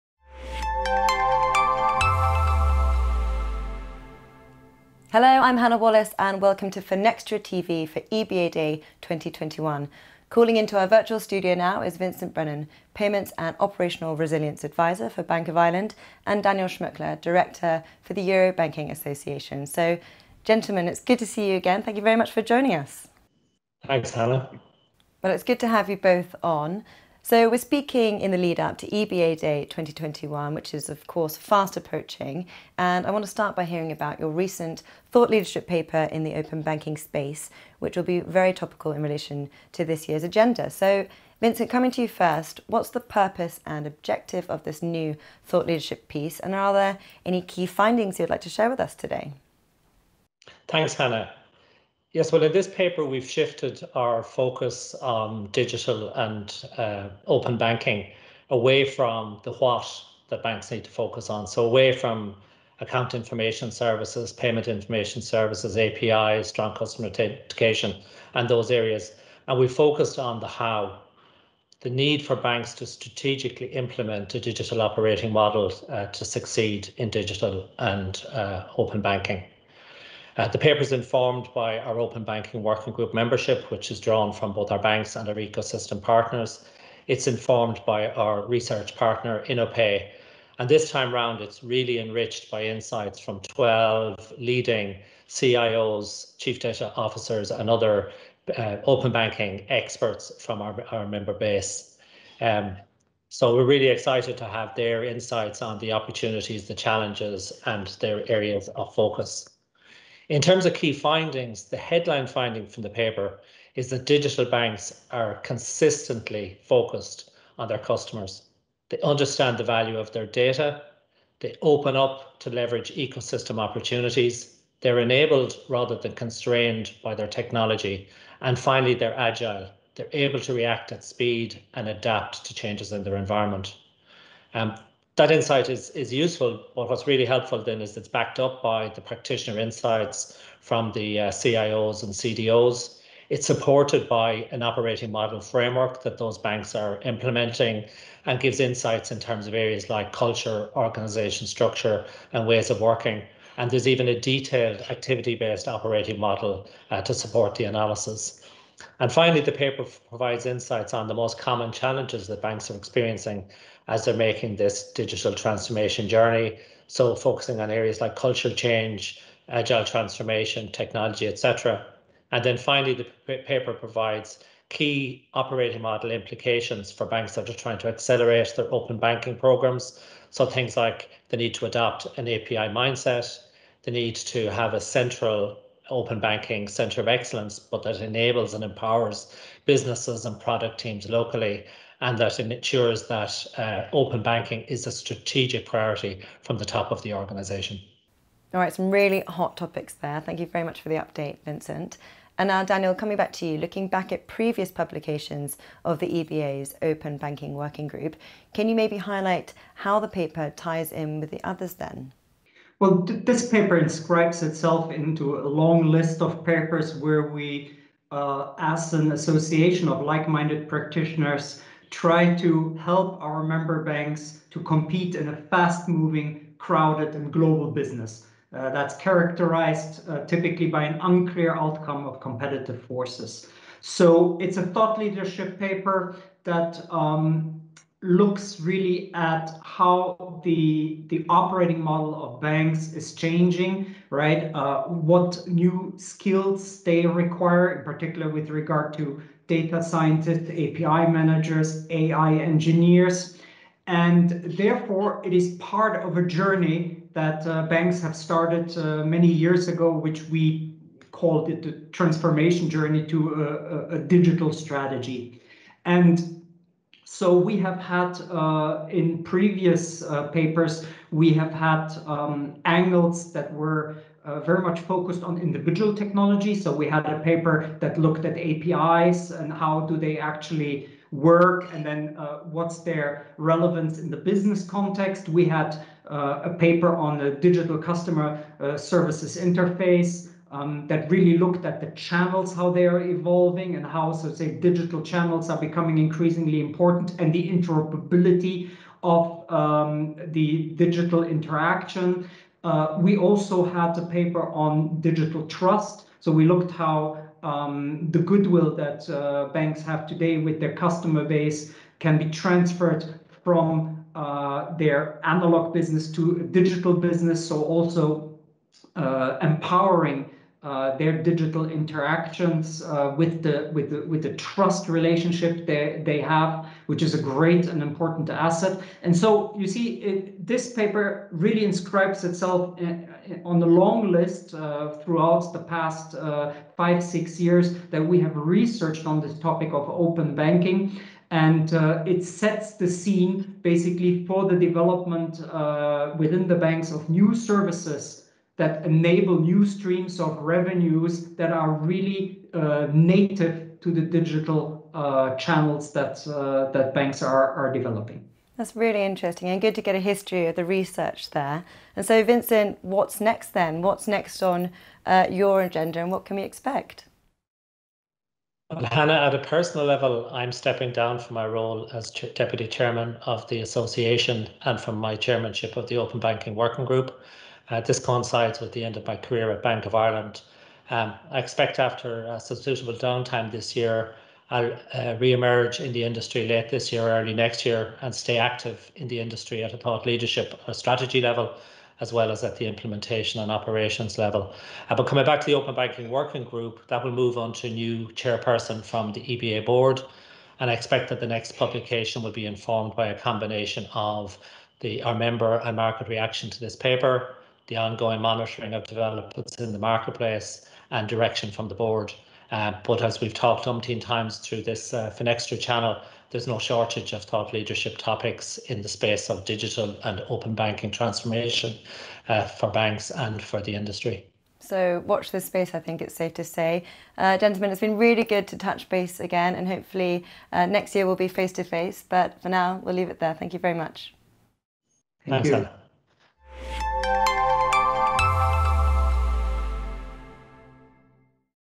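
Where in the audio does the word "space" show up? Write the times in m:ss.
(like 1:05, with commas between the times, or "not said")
0:36, 6:58, 7:05.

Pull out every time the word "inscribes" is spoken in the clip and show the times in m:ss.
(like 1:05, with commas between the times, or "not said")
3:33, 5:31.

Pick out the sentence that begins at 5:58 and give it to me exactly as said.
That's really interesting and good to get a history of the research there.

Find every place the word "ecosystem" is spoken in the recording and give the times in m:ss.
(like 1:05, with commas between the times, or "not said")
1:25, 2:02.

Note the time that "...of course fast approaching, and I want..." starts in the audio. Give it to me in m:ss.
0:30.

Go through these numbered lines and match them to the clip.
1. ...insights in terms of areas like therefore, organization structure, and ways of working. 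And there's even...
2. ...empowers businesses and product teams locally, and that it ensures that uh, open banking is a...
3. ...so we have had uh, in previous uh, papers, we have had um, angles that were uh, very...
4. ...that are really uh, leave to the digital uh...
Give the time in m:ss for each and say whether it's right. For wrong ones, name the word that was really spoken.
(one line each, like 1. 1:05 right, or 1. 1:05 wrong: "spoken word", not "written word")
1. 2:28 wrong: "culture", not "therefore"
2. 3:08 right
3. 4:27 right
4. 5:51 wrong: "native", not "leave".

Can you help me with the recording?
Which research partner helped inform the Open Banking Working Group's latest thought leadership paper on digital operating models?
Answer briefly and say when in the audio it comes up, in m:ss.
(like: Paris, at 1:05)
InnoPay, at 1:29.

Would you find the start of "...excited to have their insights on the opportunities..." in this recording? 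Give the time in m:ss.
1:43.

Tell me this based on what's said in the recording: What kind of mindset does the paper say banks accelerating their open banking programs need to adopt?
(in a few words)
API mindset.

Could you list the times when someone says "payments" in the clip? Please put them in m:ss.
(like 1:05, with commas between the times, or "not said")
0:12, 1:04.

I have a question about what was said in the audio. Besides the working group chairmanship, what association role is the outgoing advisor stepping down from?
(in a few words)
deputy chairman.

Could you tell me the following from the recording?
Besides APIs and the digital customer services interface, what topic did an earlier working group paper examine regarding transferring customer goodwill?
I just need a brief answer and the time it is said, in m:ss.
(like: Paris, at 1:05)
digital trust, at 5:04.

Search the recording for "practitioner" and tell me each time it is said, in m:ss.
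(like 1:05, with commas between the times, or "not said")
2:19, 3:40.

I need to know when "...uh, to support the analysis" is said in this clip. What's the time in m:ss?
2:36.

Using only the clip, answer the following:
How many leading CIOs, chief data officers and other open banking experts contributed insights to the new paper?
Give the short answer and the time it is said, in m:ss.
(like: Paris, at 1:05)
12, at 1:33.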